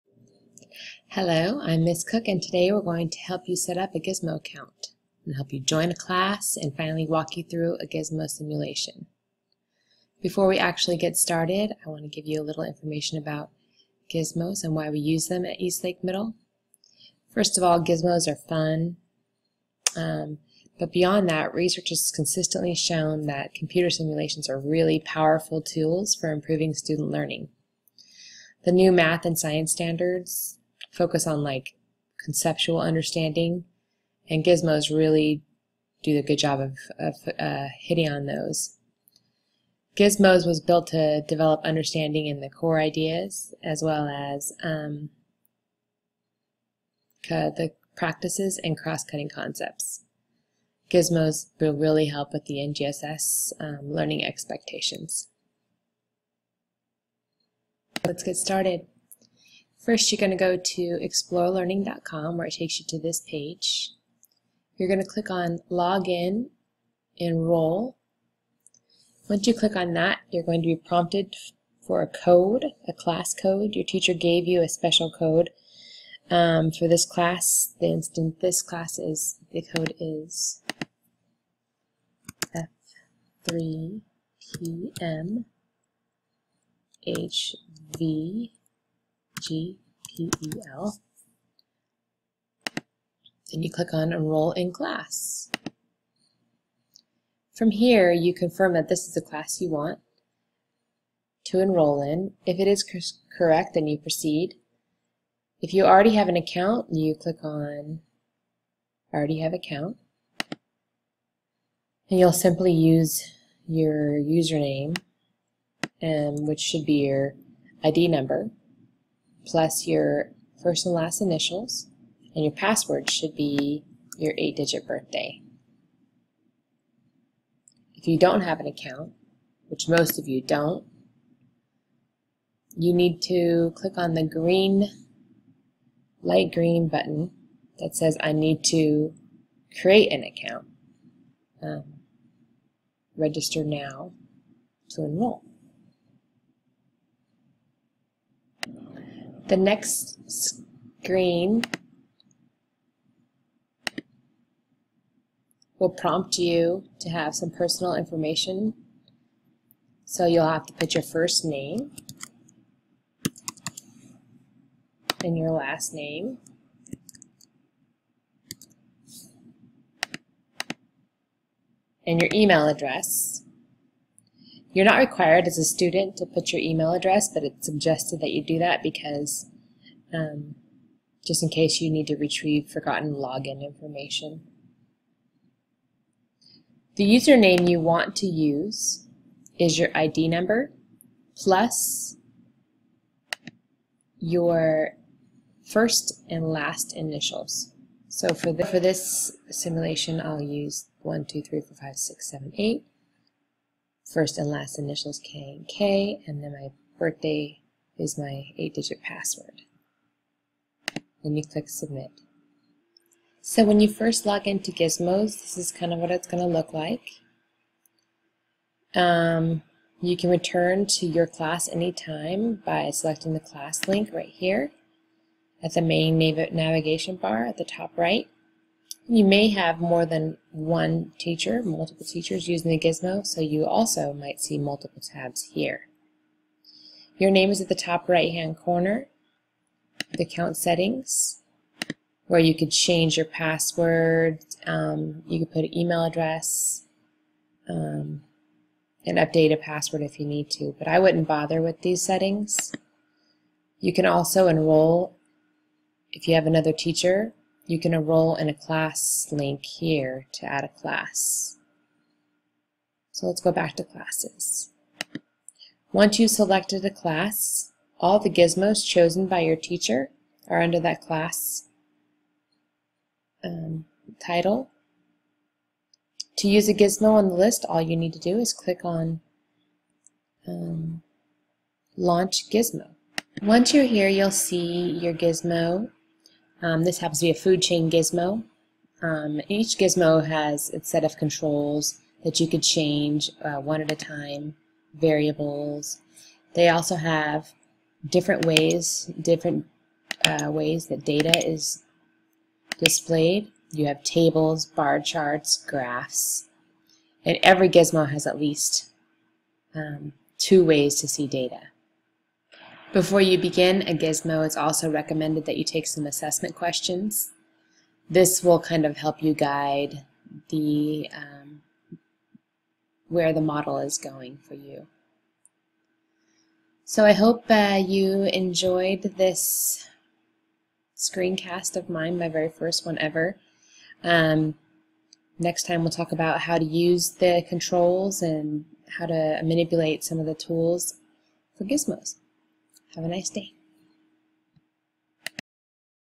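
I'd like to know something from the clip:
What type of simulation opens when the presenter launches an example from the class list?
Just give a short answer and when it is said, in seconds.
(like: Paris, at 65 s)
food chain, at 287 s.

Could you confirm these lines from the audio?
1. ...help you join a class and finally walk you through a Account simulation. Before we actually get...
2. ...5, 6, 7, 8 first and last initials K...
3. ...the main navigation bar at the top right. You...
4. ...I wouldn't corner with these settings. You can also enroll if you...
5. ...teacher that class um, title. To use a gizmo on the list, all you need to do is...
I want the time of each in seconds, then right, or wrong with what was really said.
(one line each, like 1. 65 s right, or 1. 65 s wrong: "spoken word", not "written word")
1. 5 s wrong: "Gizmo", not "Account"
2. 201 s right
3. 225 s right
4. 250 s wrong: "bother", not "corner"
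5. 270 s wrong: "under", not "teacher".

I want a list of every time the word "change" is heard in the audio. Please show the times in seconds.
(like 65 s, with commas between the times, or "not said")
242 s, 292 s.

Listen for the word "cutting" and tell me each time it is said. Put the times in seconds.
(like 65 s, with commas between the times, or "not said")
48 s.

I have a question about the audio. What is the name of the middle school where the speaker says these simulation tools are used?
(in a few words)
Eastlake Middle.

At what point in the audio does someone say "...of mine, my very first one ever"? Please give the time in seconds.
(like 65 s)
331 s.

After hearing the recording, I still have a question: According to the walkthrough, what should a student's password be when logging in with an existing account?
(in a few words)
eight-digit birthday.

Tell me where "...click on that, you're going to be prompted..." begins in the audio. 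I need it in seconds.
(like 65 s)
69 s.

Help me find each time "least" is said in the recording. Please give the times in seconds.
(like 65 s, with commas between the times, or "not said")
308 s.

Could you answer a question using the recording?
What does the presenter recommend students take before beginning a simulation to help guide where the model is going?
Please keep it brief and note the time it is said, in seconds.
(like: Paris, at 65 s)
assessment questions, at 316 s.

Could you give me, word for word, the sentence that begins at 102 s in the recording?
If it is correct, then you proceed.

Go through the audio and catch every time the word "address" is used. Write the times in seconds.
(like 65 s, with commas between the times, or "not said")
172 s, 176 s, 246 s.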